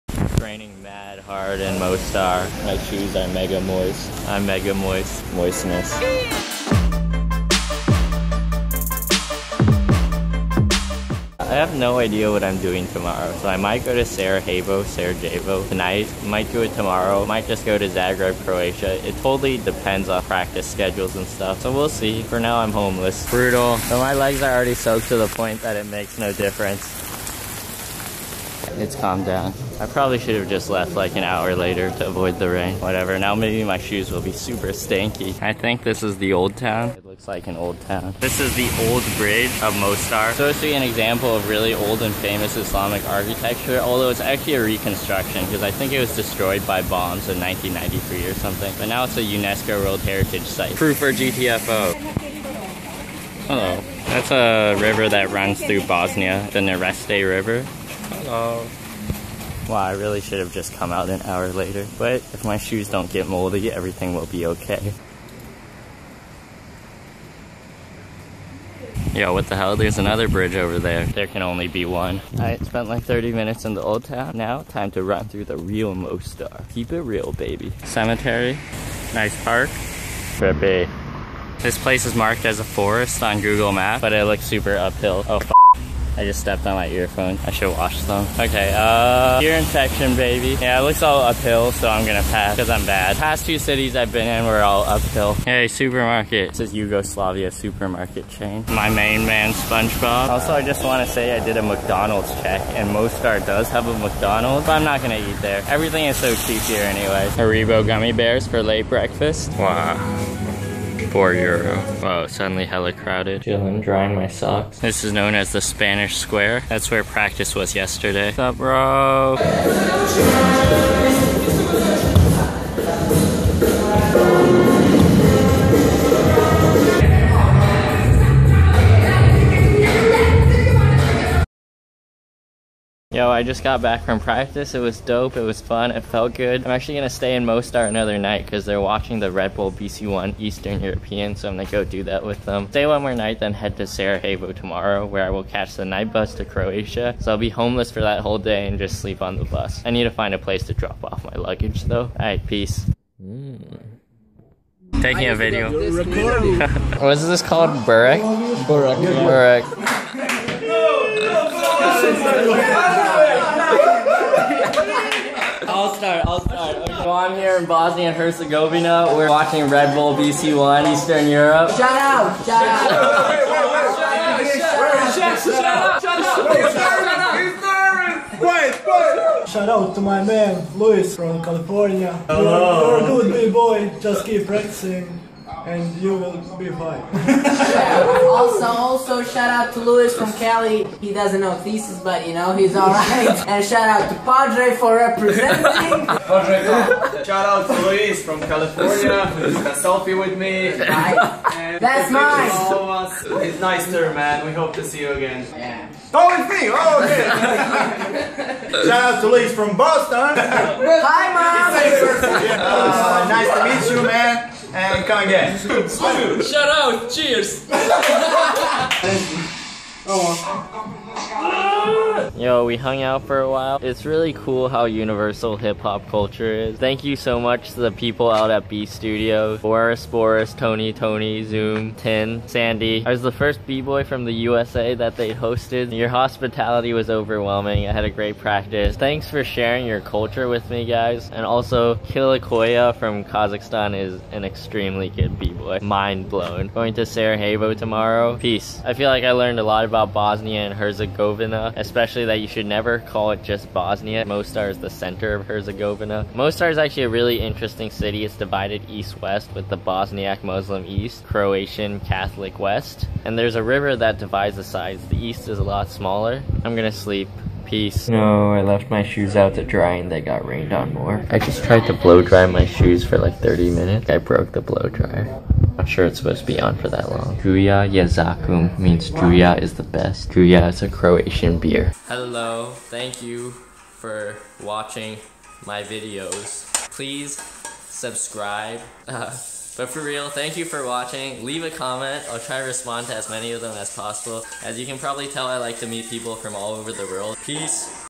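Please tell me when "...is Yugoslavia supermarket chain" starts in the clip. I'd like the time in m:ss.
1:36.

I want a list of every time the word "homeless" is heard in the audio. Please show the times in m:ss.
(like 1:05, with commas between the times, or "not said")
0:22, 2:27.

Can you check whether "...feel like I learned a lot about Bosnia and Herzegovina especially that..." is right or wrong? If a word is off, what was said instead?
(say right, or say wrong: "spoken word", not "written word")
right.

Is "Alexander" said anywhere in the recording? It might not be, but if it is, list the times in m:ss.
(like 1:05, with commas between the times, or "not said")
not said.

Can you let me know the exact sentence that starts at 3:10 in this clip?
He doesn't know thesis, but you know he's alright.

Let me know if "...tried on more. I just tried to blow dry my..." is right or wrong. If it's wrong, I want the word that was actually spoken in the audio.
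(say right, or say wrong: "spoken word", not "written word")
wrong: "rained", not "tried".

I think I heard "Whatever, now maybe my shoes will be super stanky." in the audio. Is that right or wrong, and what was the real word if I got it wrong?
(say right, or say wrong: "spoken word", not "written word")
right.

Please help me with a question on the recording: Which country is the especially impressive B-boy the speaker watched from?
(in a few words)
Kazakhstan.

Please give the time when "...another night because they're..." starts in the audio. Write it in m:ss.
2:17.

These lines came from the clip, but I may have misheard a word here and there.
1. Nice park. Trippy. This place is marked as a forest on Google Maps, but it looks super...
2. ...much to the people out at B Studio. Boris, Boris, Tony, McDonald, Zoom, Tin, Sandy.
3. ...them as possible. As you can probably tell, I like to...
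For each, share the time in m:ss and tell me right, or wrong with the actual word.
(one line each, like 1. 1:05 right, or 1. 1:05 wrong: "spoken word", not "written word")
1. 1:19 right
2. 3:47 wrong: "Tony", not "McDonald"
3. 4:53 right.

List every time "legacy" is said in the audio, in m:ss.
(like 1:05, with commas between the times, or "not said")
not said.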